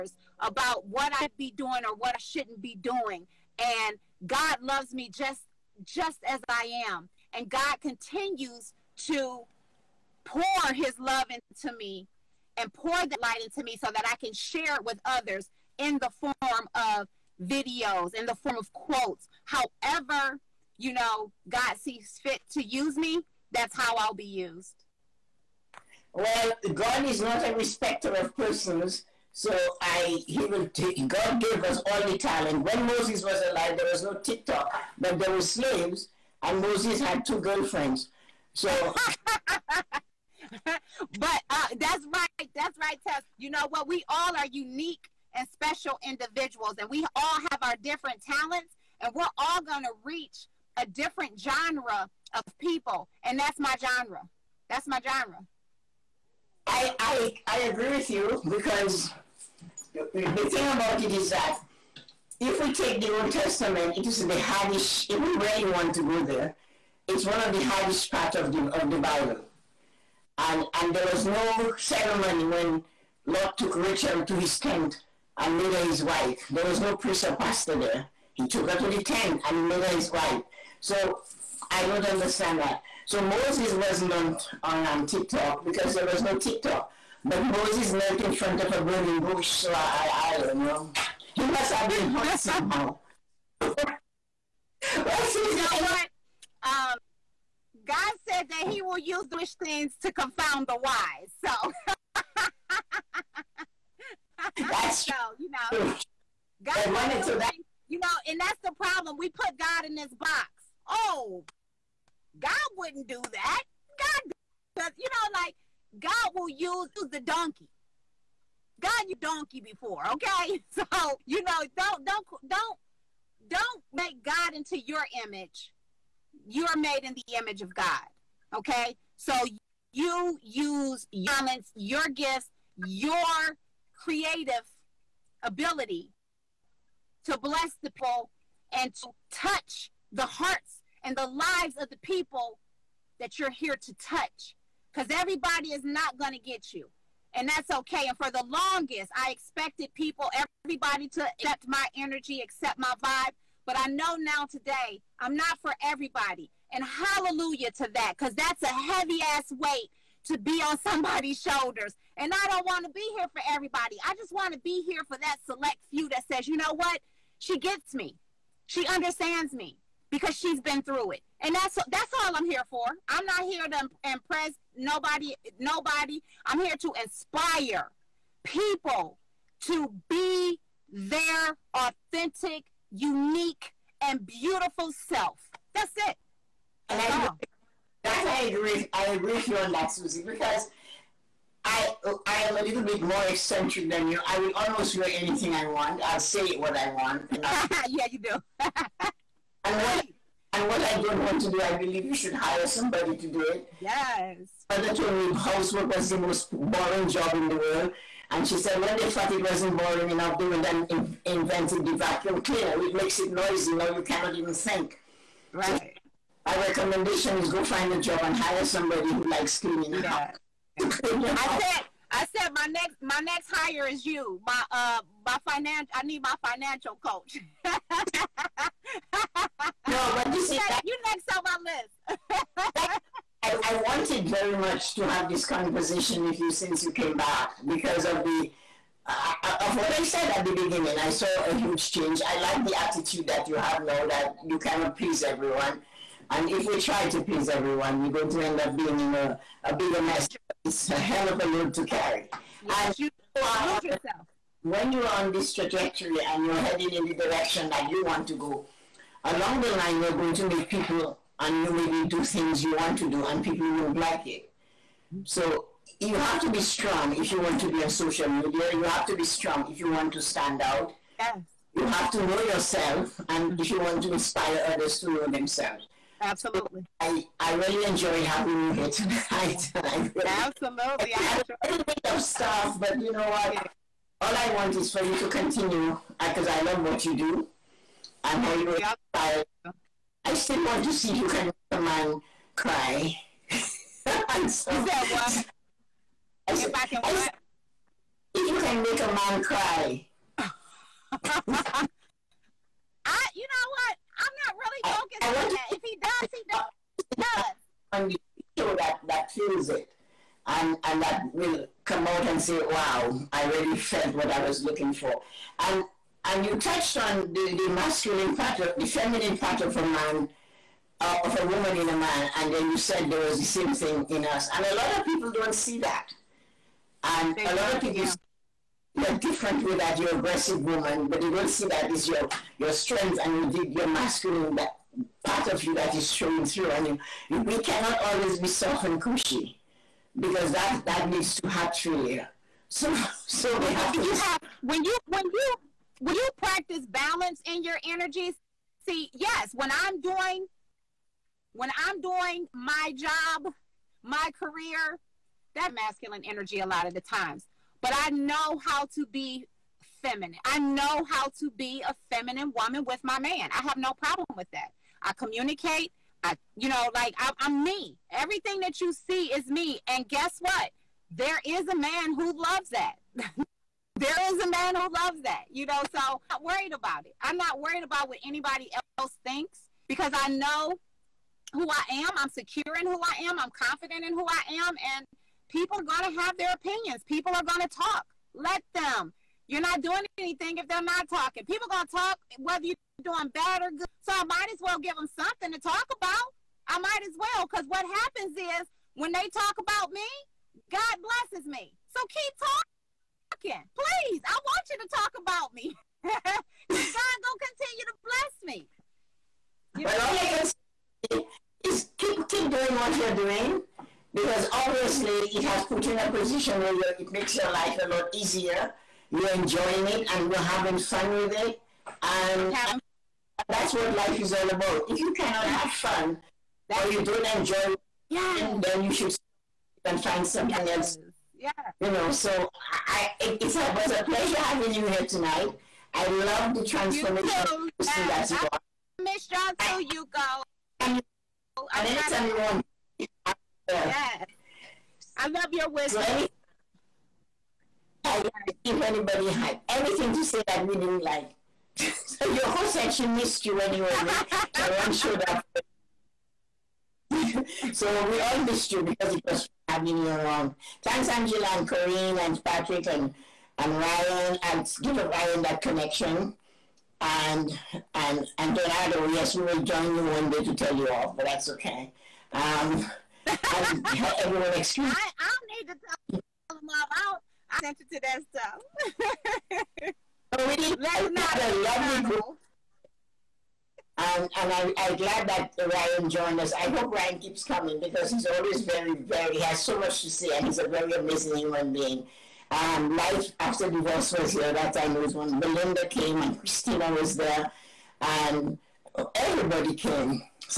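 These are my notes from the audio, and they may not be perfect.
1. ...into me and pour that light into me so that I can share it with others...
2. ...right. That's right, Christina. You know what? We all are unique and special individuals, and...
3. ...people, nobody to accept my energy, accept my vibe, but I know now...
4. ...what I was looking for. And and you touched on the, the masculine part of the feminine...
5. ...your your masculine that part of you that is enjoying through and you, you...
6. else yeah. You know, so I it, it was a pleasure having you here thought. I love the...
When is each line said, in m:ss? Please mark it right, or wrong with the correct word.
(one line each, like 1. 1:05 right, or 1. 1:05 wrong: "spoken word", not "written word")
1. 0:11 right
2. 0:42 wrong: "Tess", not "Christina"
3. 2:29 wrong: "everybody", not "nobody"
4. 5:14 right
5. 5:33 wrong: "showing", not "enjoying"
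6. 7:10 wrong: "tonight", not "thought".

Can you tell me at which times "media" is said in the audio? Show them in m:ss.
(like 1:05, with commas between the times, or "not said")
4:28.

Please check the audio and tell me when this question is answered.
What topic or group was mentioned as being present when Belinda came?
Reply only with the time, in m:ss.
8:12.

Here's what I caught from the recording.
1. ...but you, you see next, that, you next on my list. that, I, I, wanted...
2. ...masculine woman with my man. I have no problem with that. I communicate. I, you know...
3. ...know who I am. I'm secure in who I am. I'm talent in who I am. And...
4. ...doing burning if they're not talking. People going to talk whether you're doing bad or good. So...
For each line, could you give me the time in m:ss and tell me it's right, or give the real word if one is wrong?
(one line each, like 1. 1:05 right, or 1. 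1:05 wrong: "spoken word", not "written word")
1. 3:50 right
2. 6:02 wrong: "feminine", not "masculine"
3. 6:20 wrong: "confident", not "talent"
4. 6:29 wrong: "anything", not "burning".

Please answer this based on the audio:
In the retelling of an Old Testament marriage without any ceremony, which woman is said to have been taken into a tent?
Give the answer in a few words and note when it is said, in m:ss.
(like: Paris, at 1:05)
Rachel, at 1:13.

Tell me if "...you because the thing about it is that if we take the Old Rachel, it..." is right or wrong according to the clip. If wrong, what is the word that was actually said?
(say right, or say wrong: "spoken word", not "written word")
wrong: "Testament", not "Rachel".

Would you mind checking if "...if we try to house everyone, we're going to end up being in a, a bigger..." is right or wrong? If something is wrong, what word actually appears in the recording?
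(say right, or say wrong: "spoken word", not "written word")
wrong: "please", not "house".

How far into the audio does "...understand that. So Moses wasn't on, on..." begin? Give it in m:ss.
1:22.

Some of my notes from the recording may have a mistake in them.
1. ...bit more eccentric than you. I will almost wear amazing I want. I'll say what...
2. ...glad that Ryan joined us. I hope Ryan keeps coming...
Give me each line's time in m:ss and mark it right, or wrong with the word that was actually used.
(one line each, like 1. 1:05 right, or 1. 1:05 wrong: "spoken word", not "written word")
1. 3:12 wrong: "anything", not "amazing"
2. 8:04 right.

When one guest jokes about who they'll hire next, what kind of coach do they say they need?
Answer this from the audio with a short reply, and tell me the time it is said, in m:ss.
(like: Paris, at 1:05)
financial coach, at 3:46.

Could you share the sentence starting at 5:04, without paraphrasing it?
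I'm not really focused I, I want on to, that.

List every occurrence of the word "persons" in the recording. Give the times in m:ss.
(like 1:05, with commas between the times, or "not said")
0:28, 7:17.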